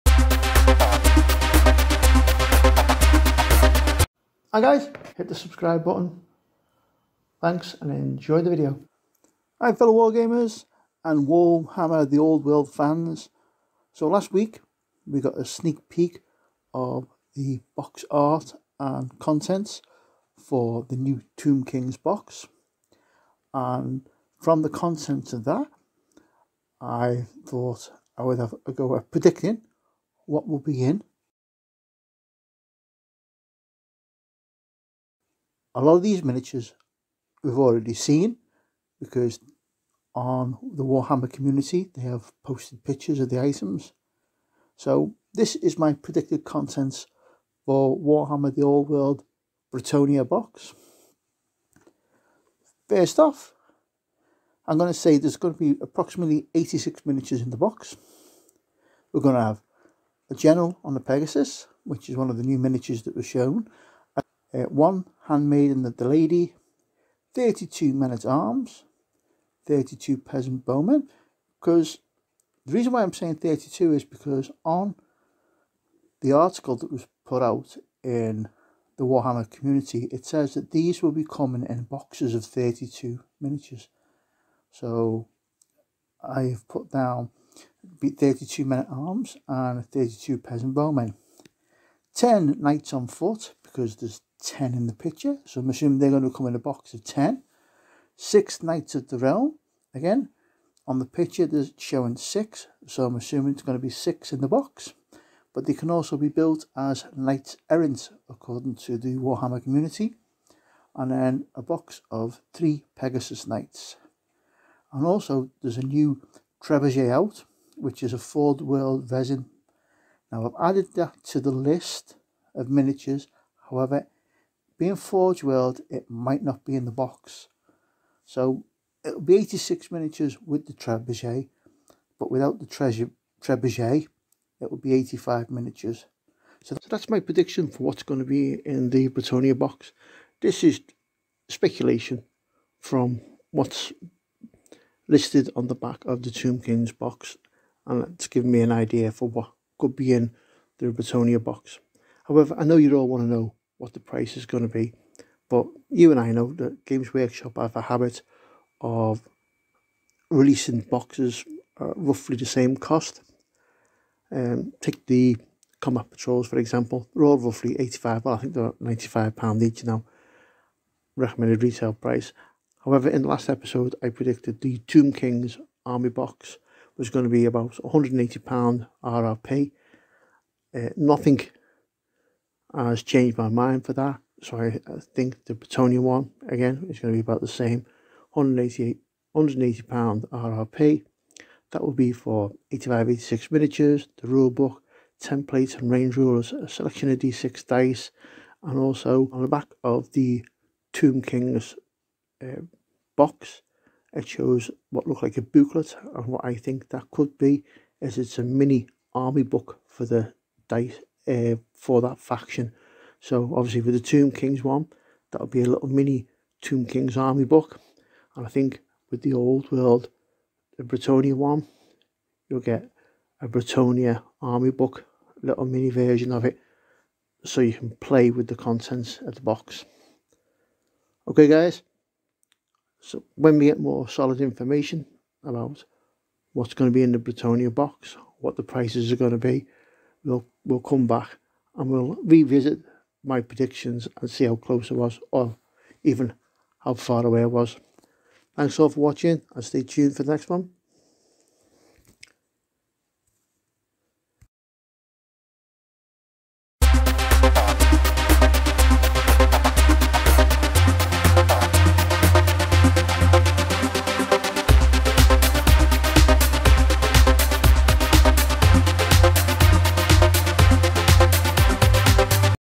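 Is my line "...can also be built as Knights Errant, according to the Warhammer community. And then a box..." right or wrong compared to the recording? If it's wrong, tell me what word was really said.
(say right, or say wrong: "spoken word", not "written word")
right.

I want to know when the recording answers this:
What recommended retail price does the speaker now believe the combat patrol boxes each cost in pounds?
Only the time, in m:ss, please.
2:48.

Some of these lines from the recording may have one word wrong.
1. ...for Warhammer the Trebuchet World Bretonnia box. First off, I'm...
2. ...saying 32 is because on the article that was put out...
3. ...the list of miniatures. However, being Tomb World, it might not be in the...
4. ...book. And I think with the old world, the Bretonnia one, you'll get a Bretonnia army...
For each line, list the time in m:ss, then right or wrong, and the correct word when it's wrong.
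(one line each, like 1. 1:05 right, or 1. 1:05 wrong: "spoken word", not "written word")
1. 0:47 wrong: "Old", not "Trebuchet"
2. 1:13 right
3. 2:01 wrong: "Forge", not "Tomb"
4. 3:37 right.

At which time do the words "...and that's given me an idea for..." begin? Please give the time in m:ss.
2:27.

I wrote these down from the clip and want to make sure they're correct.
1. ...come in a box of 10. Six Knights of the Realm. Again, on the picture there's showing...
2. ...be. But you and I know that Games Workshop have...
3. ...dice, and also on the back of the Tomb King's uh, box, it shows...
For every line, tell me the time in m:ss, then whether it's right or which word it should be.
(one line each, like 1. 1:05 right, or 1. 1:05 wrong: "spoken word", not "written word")
1. 1:36 right
2. 2:34 right
3. 3:17 right.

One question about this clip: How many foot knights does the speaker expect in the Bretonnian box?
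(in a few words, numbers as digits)
10.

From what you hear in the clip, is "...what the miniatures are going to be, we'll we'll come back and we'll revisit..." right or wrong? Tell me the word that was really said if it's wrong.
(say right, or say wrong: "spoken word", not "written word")
wrong: "prices", not "miniatures".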